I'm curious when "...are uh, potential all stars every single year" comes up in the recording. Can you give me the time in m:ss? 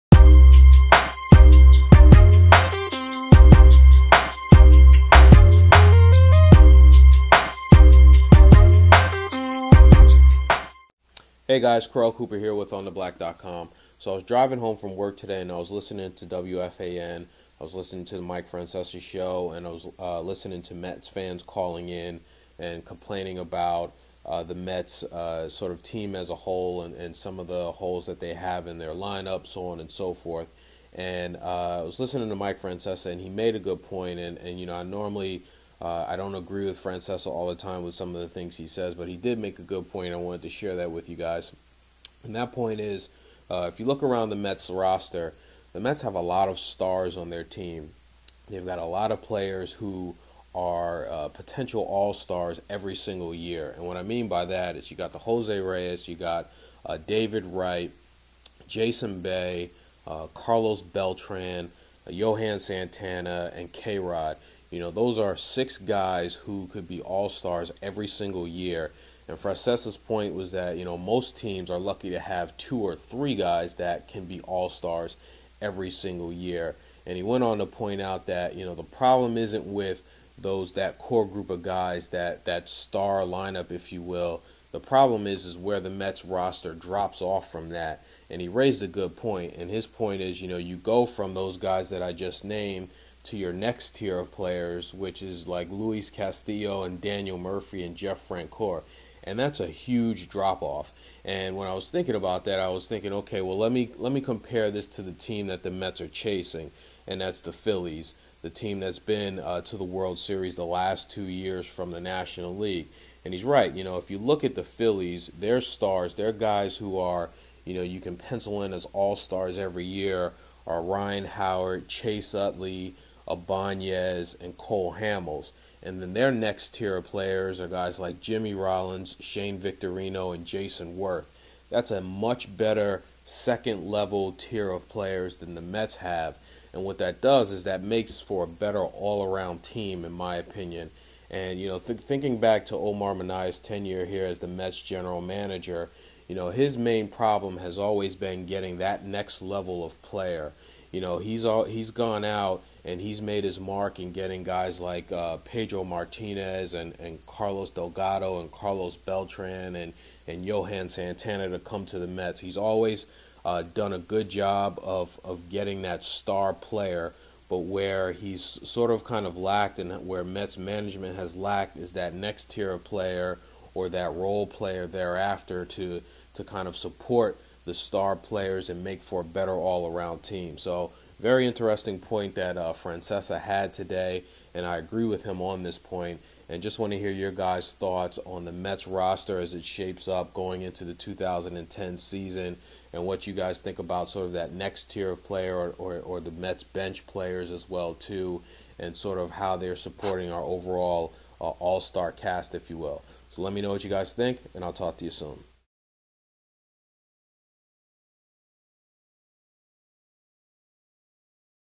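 0:50.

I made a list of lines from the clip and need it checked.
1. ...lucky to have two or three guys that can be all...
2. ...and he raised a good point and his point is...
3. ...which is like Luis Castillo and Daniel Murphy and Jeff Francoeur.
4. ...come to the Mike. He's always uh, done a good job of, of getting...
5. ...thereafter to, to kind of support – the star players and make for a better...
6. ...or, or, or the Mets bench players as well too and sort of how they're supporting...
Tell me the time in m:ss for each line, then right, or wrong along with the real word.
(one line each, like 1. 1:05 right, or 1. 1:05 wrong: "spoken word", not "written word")
1. 1:11 right
2. 1:28 right
3. 1:34 right
4. 2:41 wrong: "Mets", not "Mike"
5. 2:54 right
6. 3:15 right.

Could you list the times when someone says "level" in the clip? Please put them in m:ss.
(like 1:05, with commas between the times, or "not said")
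2:13, 2:29.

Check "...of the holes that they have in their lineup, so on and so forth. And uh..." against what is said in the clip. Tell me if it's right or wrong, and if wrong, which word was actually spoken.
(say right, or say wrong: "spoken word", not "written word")
right.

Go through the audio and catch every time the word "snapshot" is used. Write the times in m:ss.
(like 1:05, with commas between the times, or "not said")
not said.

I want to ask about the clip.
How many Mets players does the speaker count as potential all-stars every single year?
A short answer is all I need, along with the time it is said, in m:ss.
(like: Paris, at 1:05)
6, at 1:05.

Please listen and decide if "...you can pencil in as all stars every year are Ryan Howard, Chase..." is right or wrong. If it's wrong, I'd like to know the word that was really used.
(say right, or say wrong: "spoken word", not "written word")
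right.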